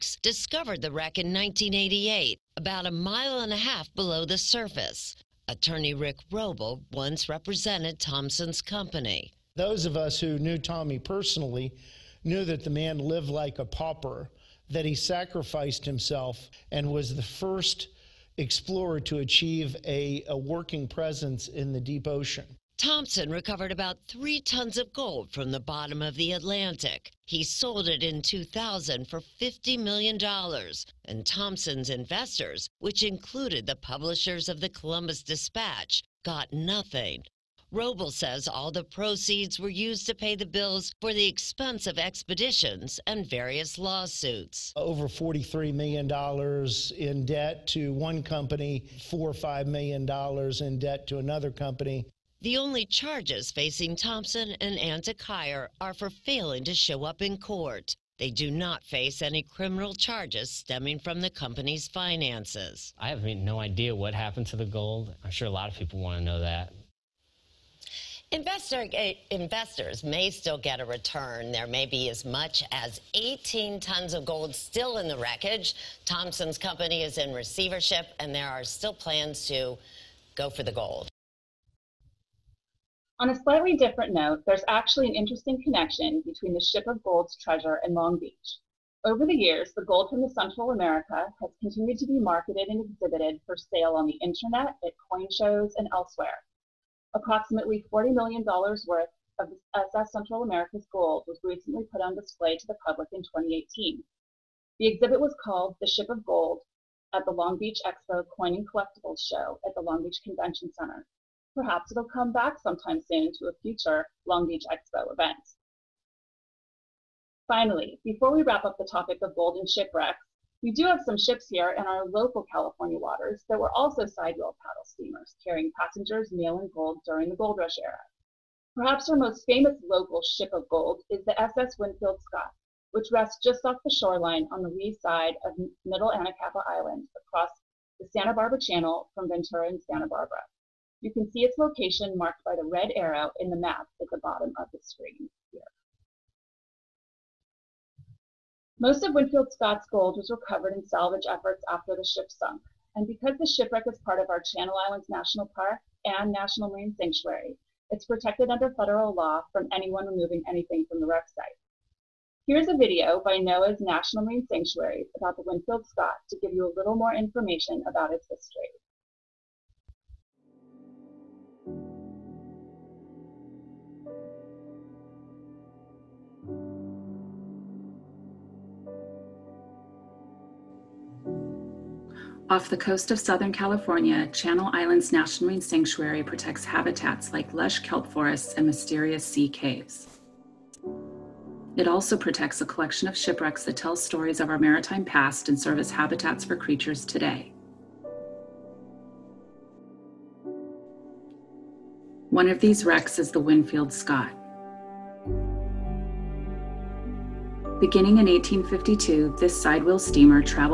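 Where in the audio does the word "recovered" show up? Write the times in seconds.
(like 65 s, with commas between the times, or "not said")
23 s, 150 s.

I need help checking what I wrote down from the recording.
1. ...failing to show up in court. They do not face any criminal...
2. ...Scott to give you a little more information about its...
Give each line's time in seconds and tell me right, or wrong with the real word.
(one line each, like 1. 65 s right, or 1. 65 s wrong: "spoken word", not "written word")
1. 56 s right
2. 165 s right.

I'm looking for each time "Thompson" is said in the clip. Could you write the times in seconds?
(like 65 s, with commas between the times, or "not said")
7 s, 22 s, 31 s, 53 s, 76 s.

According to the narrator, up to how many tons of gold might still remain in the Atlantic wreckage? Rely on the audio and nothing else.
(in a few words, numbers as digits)
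18 tons.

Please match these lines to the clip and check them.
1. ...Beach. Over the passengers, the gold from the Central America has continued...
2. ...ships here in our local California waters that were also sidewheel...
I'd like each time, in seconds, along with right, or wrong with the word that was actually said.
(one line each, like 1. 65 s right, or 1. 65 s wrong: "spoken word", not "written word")
1. 88 s wrong: "years", not "passengers"
2. 121 s right.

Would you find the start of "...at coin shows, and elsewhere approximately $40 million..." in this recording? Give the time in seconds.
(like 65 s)
94 s.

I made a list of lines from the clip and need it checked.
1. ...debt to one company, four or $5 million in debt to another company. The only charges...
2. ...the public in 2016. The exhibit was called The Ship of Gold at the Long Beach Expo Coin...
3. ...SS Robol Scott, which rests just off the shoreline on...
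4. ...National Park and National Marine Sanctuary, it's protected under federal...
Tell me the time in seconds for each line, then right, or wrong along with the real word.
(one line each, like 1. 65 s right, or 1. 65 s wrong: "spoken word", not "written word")
1. 47 s right
2. 102 s wrong: "2018", not "2016"
3. 131 s wrong: "Winfield", not "Robol"
4. 155 s right.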